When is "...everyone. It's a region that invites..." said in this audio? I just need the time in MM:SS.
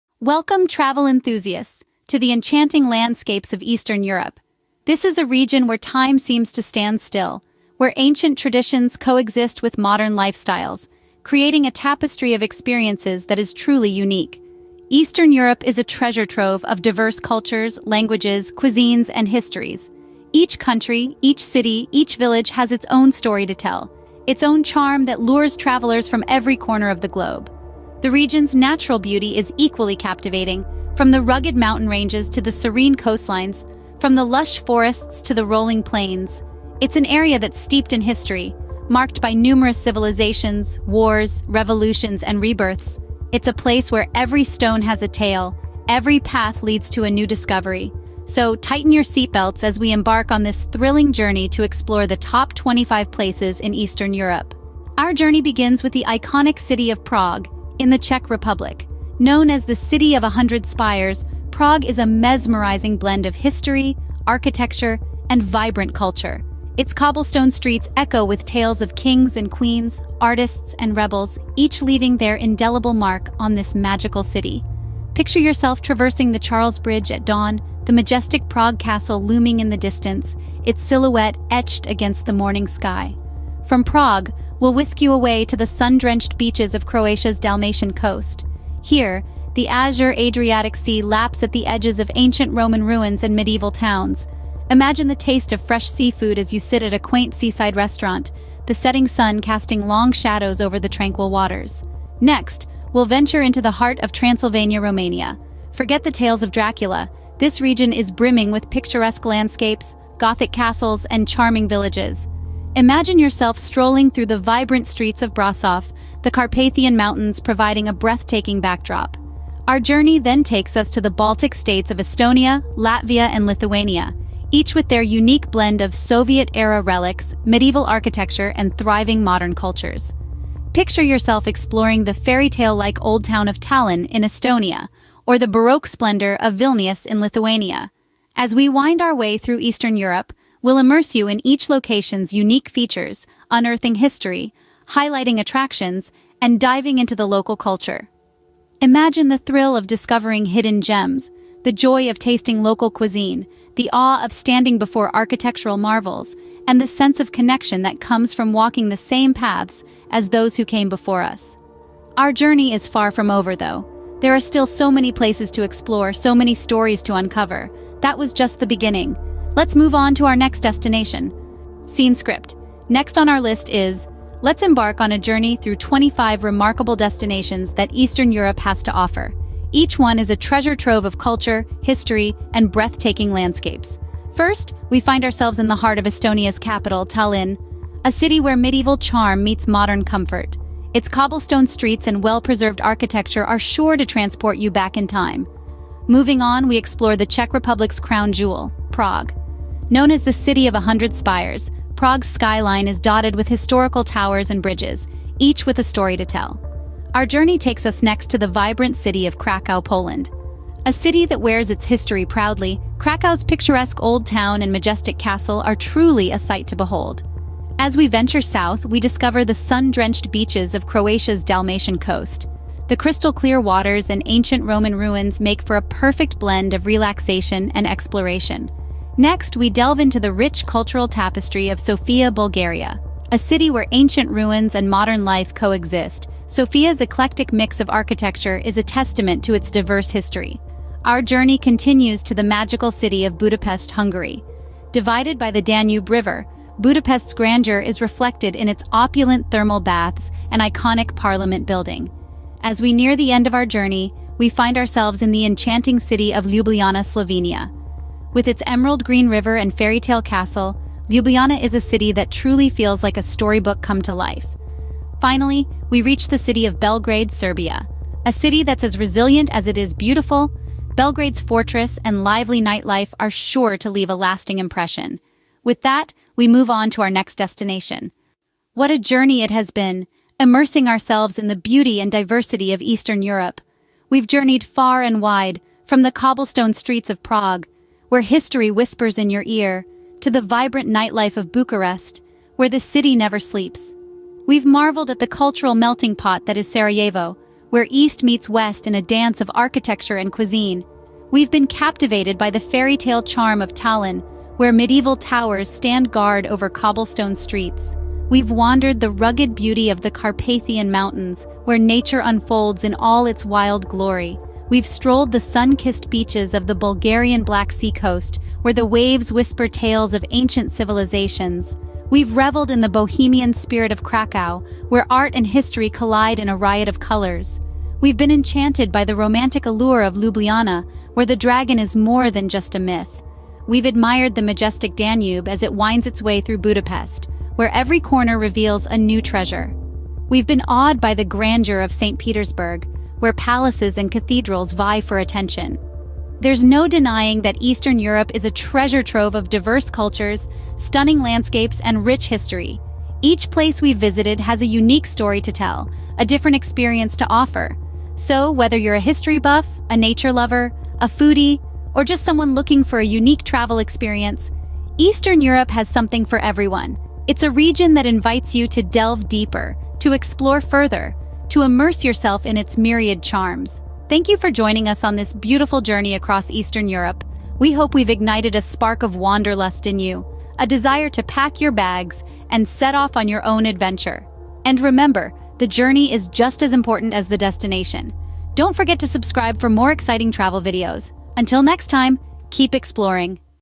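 06:06.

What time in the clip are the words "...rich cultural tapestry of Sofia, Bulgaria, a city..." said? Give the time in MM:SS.
03:50.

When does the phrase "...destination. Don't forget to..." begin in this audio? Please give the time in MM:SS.
06:27.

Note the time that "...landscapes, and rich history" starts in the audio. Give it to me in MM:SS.
05:51.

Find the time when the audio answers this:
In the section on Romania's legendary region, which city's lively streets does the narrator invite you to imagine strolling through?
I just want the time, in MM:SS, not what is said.
01:55.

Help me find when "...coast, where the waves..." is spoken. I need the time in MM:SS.
05:17.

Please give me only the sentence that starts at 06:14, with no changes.
Thank you for joining us on this beautiful journey across Eastern Europe.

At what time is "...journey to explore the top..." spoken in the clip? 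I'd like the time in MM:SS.
00:51.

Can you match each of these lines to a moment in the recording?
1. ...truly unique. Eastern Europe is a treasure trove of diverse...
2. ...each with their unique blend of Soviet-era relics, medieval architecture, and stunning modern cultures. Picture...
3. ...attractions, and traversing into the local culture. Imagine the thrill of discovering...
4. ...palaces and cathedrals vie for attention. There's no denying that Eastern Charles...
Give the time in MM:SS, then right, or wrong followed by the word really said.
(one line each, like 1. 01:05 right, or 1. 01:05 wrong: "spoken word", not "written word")
1. 00:13 right
2. 02:04 wrong: "thriving", not "stunning"
3. 02:25 wrong: "diving", not "traversing"
4. 05:43 wrong: "Europe", not "Charles".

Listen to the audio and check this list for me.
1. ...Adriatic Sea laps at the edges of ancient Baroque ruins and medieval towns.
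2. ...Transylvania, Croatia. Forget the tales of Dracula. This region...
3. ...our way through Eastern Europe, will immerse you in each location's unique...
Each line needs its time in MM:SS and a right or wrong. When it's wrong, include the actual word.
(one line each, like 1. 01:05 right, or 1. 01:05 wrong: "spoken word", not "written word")
1. 01:30 wrong: "Roman", not "Baroque"
2. 01:44 wrong: "Romania", not "Croatia"
3. 02:19 right.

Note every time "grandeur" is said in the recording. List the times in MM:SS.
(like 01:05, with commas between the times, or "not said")
04:07, 05:41.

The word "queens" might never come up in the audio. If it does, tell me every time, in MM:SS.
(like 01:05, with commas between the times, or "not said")
01:09.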